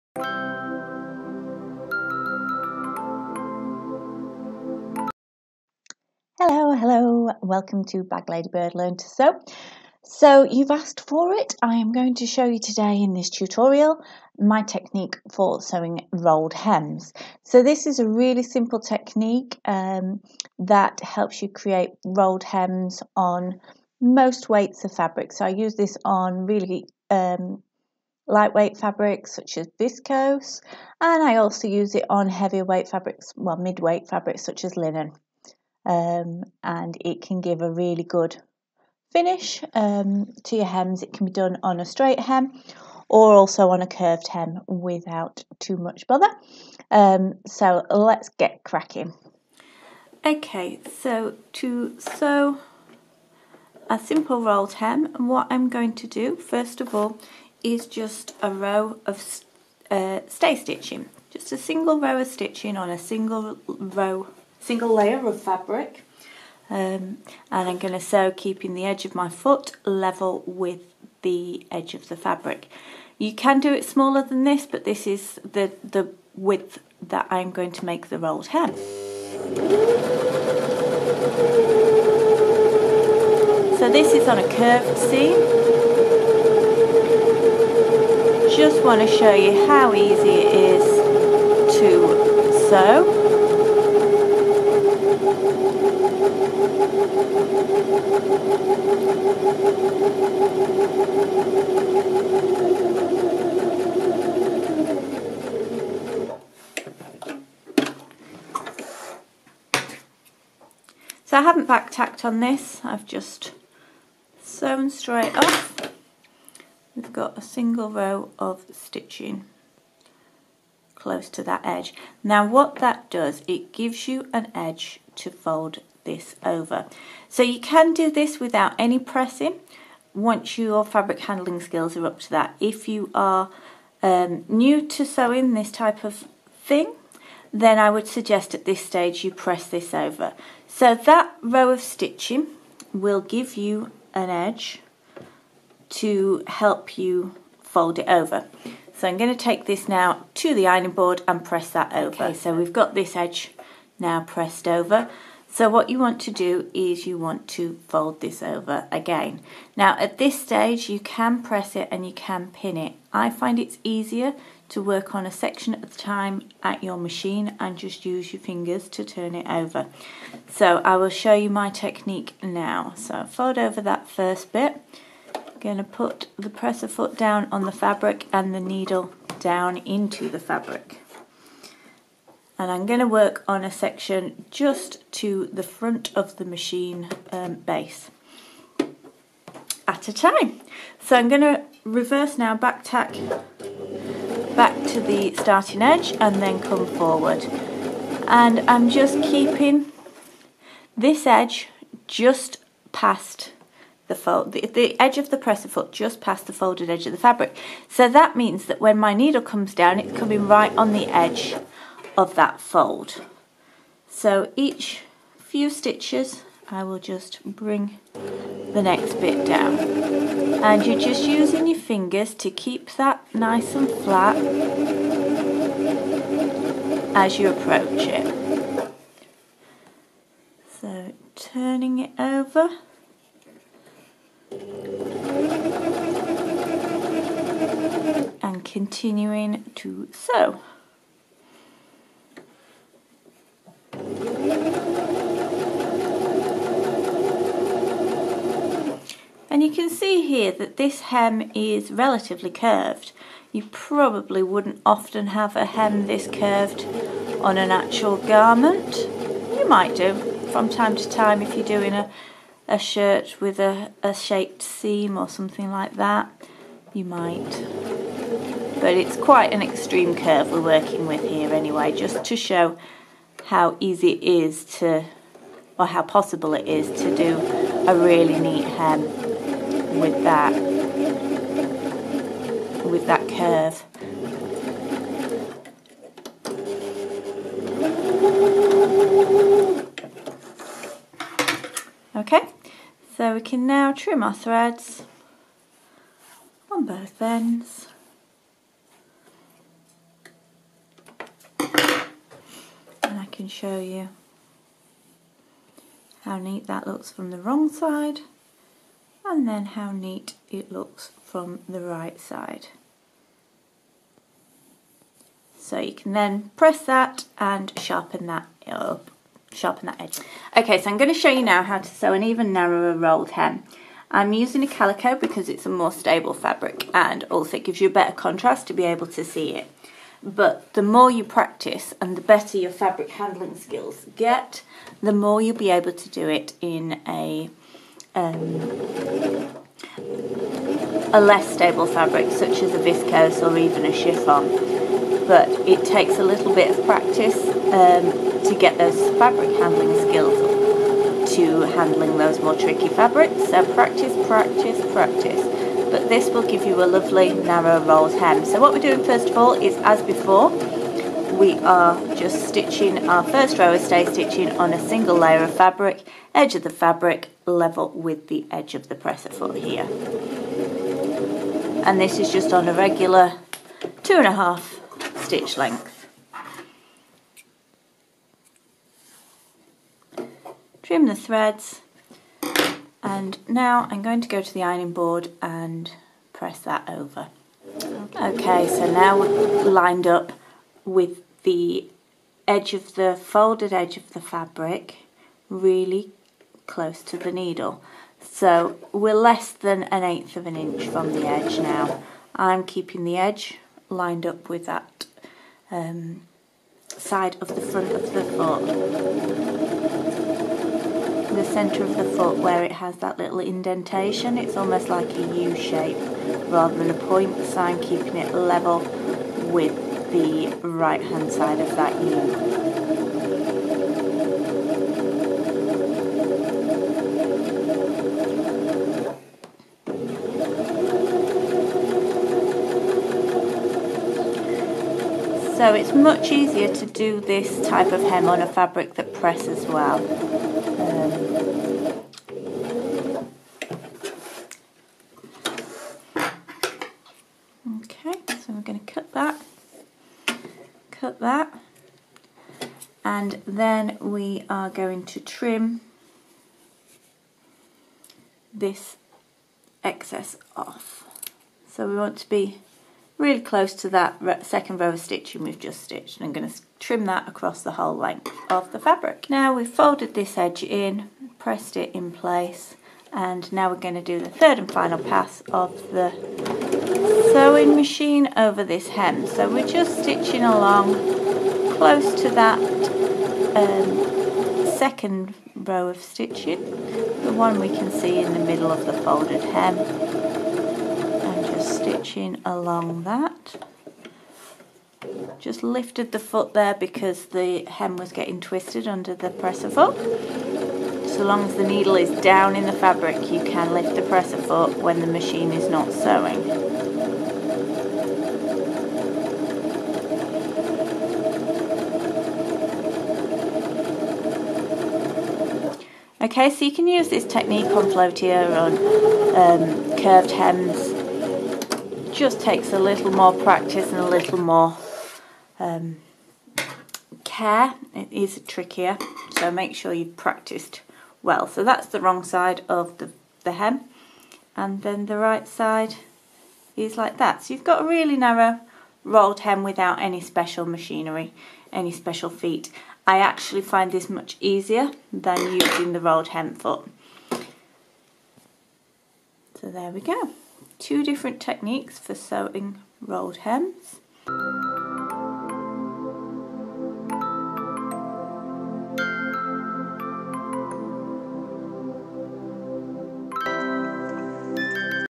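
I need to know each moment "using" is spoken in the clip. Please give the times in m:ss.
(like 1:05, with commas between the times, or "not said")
3:41, 5:24, 9:05.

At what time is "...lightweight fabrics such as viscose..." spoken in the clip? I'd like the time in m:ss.
0:28.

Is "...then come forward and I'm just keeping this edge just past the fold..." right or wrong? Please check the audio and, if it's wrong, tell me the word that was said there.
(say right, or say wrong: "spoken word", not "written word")
right.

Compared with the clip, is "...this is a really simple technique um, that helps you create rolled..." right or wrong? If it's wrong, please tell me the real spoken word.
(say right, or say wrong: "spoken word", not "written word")
right.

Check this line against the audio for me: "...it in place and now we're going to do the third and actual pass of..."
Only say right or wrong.
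wrong.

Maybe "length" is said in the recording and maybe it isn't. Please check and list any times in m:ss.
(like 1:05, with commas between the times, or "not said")
6:15, 7:47.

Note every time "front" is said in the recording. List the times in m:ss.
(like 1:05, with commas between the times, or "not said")
3:05, 6:47.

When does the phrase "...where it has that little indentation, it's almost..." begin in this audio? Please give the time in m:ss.
6:52.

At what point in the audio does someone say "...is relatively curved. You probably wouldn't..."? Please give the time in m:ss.
4:11.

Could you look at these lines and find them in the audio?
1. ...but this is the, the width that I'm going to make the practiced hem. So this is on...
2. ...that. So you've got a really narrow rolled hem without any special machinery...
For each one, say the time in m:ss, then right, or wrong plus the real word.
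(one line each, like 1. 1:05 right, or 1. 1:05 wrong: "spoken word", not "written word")
1. 1:14 wrong: "rolled", not "practiced"
2. 8:57 right.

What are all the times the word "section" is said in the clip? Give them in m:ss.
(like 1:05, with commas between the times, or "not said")
2:45, 3:03.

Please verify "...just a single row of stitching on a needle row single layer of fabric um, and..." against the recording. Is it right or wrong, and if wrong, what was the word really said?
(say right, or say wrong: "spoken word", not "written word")
wrong: "single", not "needle".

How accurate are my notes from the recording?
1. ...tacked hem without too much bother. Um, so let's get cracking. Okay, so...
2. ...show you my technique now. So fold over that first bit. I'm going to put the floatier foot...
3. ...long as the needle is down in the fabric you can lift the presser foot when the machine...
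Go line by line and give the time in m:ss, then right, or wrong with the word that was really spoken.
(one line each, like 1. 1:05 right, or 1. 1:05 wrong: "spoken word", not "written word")
1. 0:43 wrong: "curved", not "tacked"
2. 2:51 wrong: "presser", not "floatier"
3. 8:21 right.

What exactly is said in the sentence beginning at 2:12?
If you are um, new to sewing this type of thing, then I would suggest at this stage you press this over.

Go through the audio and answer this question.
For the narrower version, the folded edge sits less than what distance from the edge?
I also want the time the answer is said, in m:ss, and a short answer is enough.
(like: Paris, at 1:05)
an eighth of an inch, at 6:39.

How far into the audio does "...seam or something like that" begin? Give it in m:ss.
4:24.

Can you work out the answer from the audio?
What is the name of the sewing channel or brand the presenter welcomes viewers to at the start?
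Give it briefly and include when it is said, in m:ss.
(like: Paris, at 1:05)
Bag Ladybird, at 0:08.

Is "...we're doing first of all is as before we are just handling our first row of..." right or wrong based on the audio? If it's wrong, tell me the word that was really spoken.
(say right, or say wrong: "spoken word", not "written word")
wrong: "stitching", not "handling".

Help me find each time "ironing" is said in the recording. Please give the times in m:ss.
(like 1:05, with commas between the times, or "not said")
2:30, 6:24.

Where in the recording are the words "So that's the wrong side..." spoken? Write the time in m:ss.
8:51.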